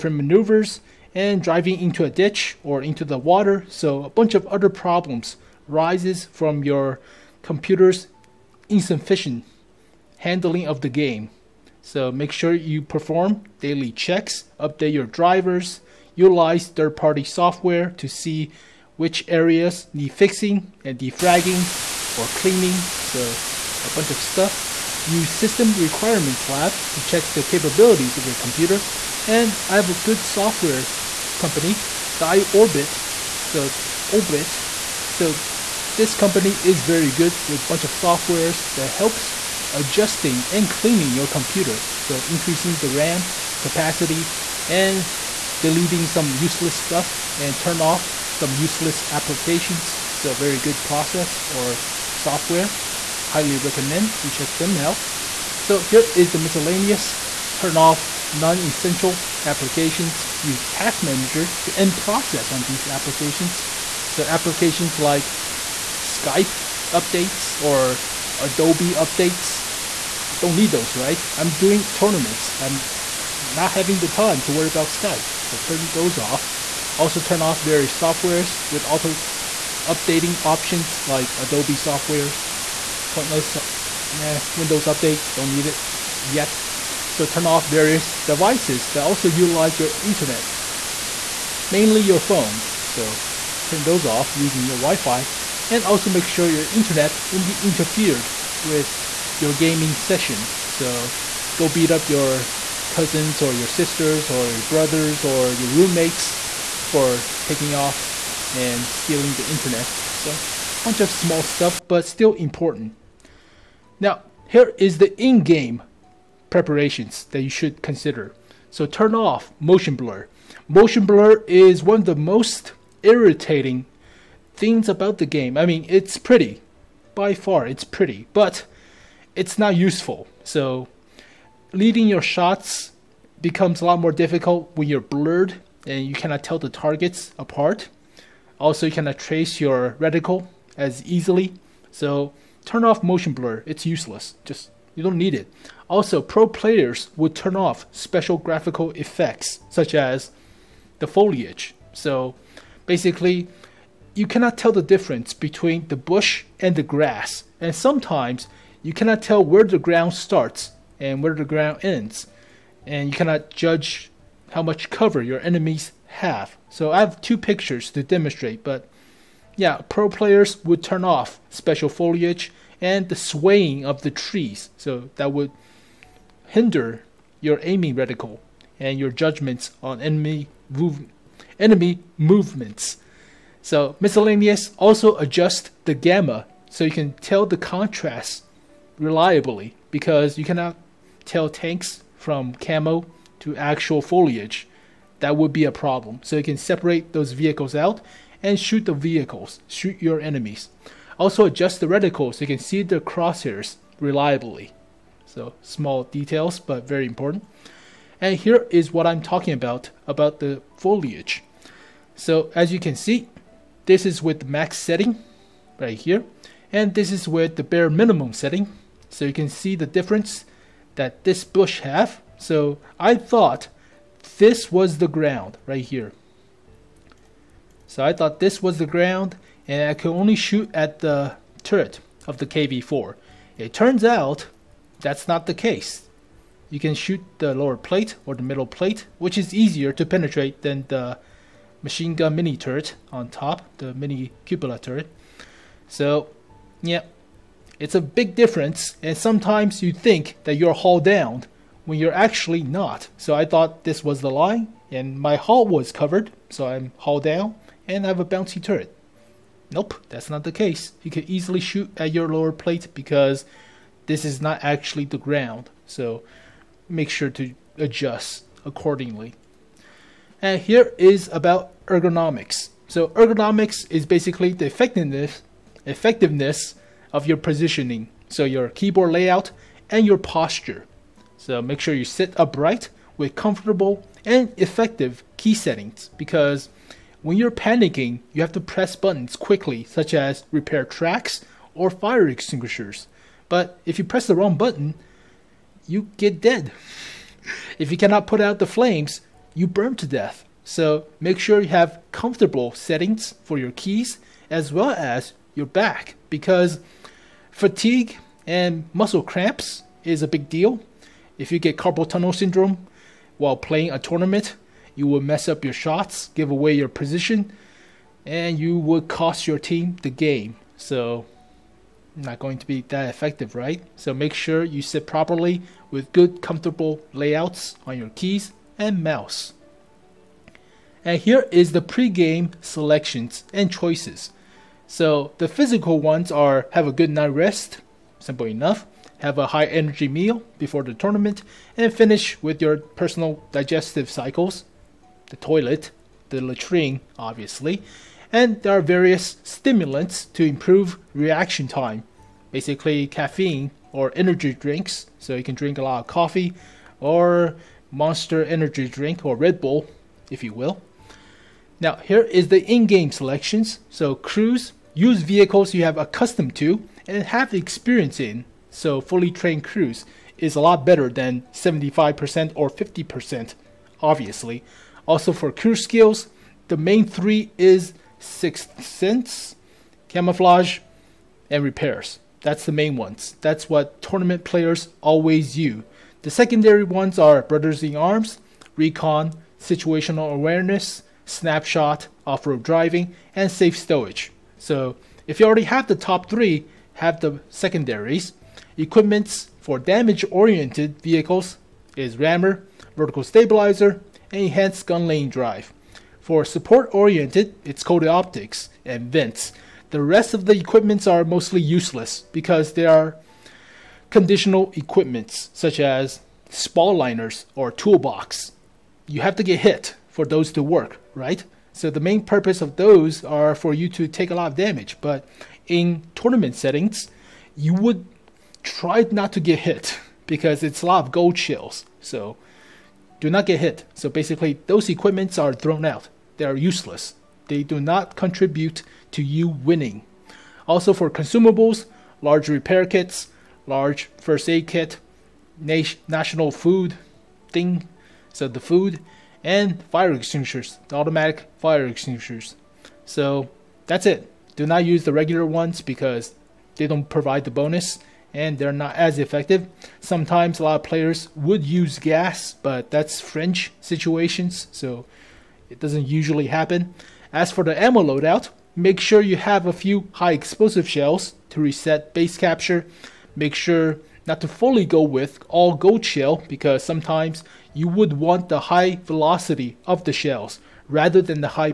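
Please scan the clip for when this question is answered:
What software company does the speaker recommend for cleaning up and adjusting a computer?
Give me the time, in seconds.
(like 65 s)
32 s.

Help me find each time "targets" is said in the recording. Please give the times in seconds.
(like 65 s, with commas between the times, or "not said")
136 s.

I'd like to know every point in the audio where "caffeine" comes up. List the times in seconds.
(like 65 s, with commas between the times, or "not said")
353 s.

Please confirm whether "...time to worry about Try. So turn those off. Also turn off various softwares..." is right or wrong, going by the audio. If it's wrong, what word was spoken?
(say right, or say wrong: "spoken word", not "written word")
wrong: "Skype", not "Try".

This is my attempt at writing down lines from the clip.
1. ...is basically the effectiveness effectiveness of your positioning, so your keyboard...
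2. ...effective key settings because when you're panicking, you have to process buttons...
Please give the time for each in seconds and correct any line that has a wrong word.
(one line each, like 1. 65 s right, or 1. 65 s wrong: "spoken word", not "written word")
1. 273 s right
2. 284 s wrong: "press", not "process".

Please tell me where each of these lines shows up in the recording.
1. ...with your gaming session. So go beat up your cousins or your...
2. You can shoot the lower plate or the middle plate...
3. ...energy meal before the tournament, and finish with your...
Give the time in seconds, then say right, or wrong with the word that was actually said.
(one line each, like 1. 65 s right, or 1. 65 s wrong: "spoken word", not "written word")
1. 98 s right
2. 236 s right
3. 339 s right.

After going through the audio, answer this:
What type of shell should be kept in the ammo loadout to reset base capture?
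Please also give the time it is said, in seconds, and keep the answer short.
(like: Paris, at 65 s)
high explosive, at 470 s.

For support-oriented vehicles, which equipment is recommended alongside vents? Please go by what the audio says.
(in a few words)
coated optics.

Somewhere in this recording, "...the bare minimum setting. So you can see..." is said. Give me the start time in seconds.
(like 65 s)
217 s.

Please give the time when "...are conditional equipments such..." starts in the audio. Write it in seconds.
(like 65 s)
412 s.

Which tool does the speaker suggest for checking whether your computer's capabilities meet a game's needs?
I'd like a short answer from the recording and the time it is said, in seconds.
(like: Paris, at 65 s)
System Requirements Lab, at 25 s.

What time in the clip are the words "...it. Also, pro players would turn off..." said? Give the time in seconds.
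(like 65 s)
145 s.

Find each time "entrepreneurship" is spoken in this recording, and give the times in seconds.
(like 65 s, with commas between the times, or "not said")
not said.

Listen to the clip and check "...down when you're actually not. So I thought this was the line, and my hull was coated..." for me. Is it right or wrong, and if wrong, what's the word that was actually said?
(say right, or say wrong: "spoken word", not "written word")
wrong: "covered", not "coated".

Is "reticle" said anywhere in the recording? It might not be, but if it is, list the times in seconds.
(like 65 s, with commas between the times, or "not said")
139 s, 177 s, 201 s.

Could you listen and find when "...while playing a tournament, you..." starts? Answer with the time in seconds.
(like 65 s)
313 s.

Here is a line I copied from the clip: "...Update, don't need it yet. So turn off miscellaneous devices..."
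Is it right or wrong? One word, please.
wrong.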